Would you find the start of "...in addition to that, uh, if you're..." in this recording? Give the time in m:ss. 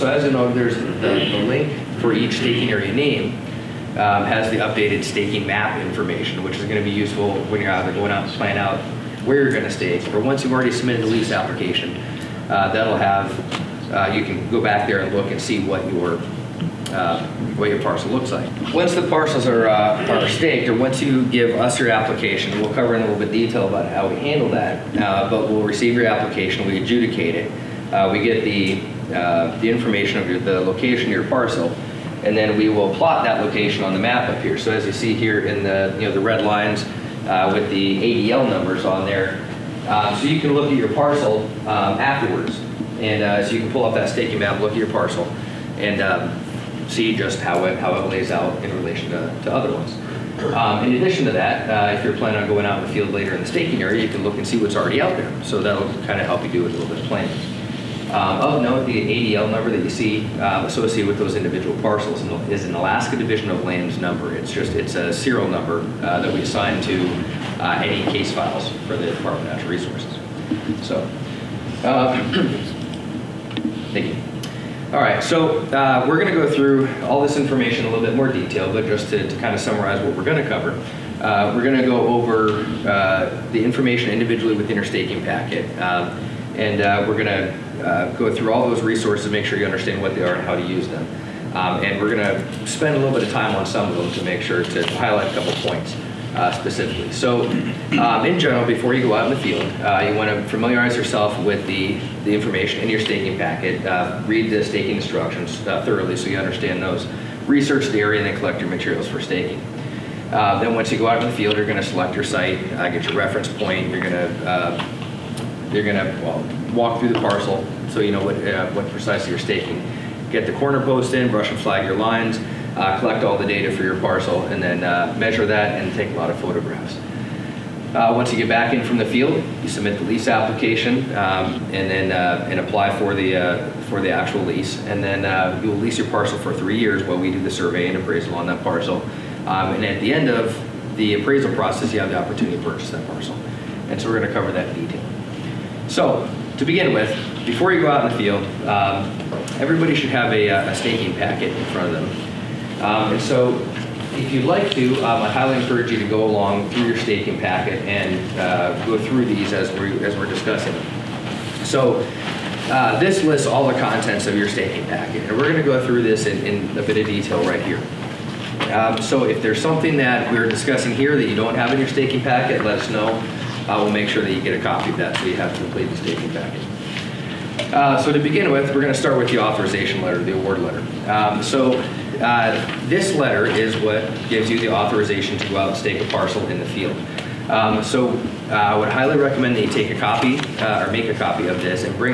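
0:50.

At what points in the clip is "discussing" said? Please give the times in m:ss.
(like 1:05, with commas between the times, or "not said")
2:40, 2:50.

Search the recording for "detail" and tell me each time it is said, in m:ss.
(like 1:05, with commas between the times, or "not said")
0:23, 1:18, 2:24, 2:47.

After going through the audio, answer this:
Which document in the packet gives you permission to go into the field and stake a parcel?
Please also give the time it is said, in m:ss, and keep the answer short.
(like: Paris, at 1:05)
The authorization letter, at 2:59.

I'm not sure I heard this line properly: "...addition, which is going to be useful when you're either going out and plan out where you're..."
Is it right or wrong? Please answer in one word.
wrong.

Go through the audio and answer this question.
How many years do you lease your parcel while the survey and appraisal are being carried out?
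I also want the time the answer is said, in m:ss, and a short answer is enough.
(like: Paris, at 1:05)
3, at 2:16.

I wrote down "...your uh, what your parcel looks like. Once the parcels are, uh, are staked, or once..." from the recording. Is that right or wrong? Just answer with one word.
right.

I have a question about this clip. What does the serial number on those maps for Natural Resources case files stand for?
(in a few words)
Alaska Division of Lands.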